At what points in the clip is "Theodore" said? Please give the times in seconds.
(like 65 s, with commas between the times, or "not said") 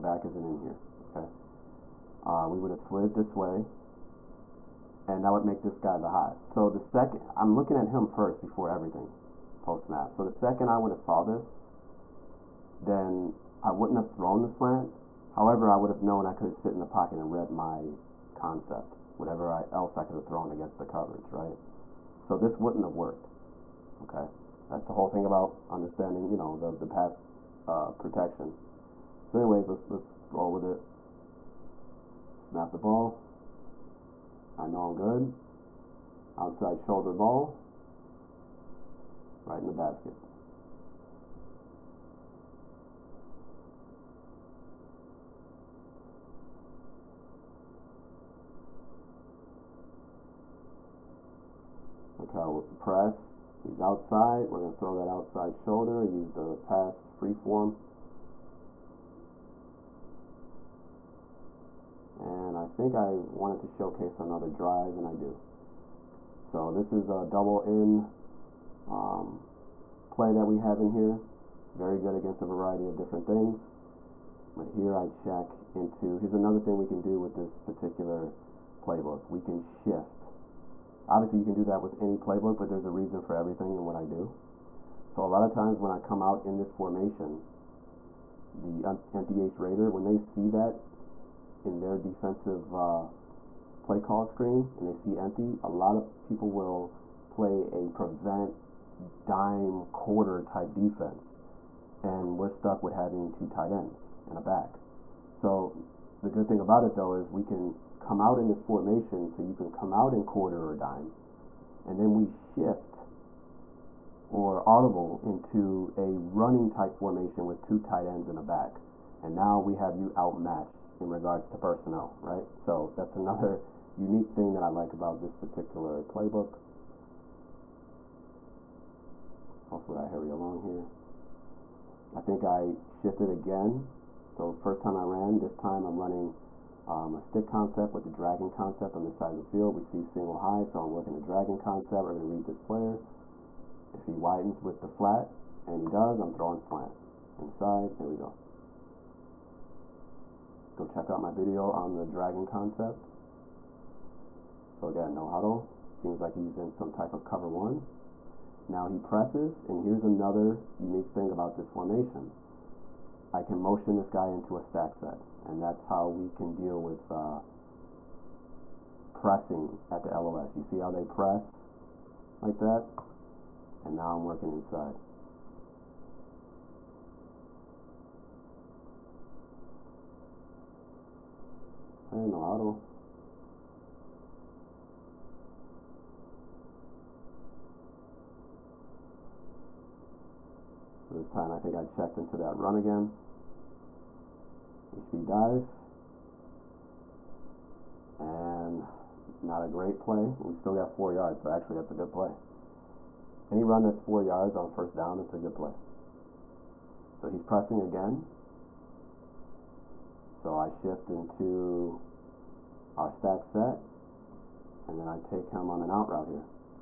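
not said.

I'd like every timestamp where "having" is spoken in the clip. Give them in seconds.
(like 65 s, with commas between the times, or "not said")
102 s.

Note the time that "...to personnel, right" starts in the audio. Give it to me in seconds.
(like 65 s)
121 s.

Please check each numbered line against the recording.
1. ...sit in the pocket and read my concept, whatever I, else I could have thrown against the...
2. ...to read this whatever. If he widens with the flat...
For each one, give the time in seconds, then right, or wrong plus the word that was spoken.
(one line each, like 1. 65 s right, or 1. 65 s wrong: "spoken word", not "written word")
1. 16 s right
2. 142 s wrong: "player", not "whatever".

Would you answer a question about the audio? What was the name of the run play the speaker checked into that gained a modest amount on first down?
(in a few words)
Speed dive.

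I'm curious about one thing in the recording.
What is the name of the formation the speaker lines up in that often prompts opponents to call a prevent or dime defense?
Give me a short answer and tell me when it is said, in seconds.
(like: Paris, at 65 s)
Empty H Raider, at 89 s.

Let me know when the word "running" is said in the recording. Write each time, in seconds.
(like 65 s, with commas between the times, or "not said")
116 s, 135 s.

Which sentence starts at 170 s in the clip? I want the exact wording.
You see how they press like that?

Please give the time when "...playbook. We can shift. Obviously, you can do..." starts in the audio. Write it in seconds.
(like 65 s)
78 s.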